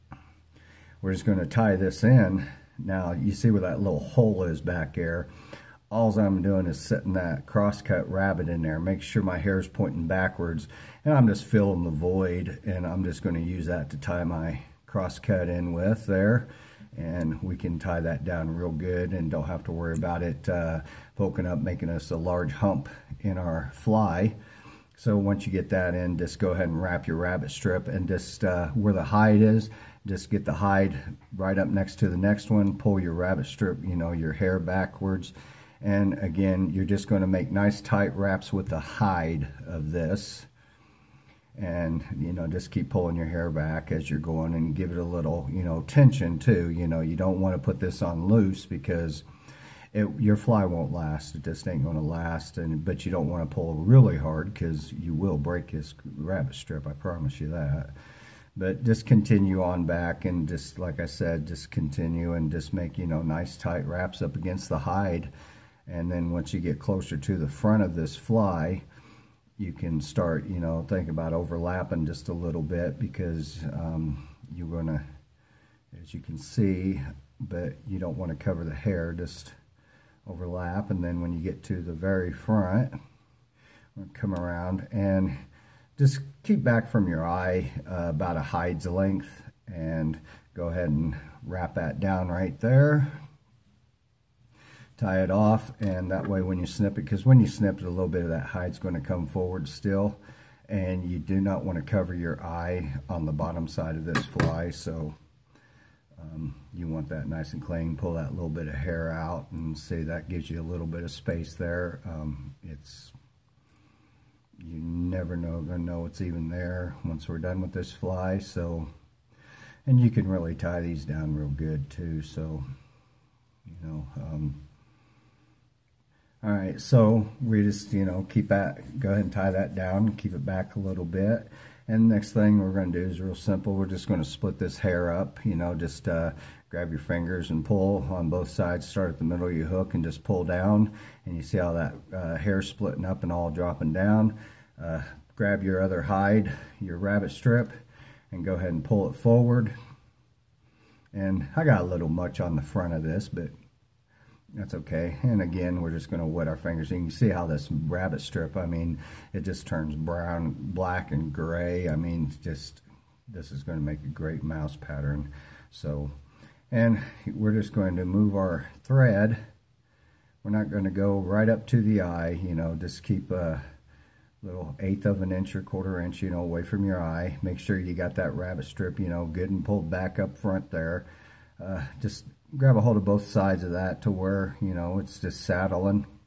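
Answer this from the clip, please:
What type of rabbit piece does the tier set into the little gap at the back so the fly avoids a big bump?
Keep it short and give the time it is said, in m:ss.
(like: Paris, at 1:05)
Crosscut rabbit, at 0:07.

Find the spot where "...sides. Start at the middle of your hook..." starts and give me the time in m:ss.
2:18.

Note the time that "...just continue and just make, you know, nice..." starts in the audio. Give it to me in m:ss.
1:01.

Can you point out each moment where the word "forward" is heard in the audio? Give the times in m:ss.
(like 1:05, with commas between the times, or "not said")
1:39, 2:29.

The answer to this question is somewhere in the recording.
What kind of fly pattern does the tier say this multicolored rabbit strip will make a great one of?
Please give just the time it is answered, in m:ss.
2:44.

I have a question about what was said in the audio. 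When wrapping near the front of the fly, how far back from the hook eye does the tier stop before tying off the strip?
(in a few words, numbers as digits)
About a hide's length.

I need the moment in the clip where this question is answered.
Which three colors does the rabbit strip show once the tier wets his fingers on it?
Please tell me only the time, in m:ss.
2:39.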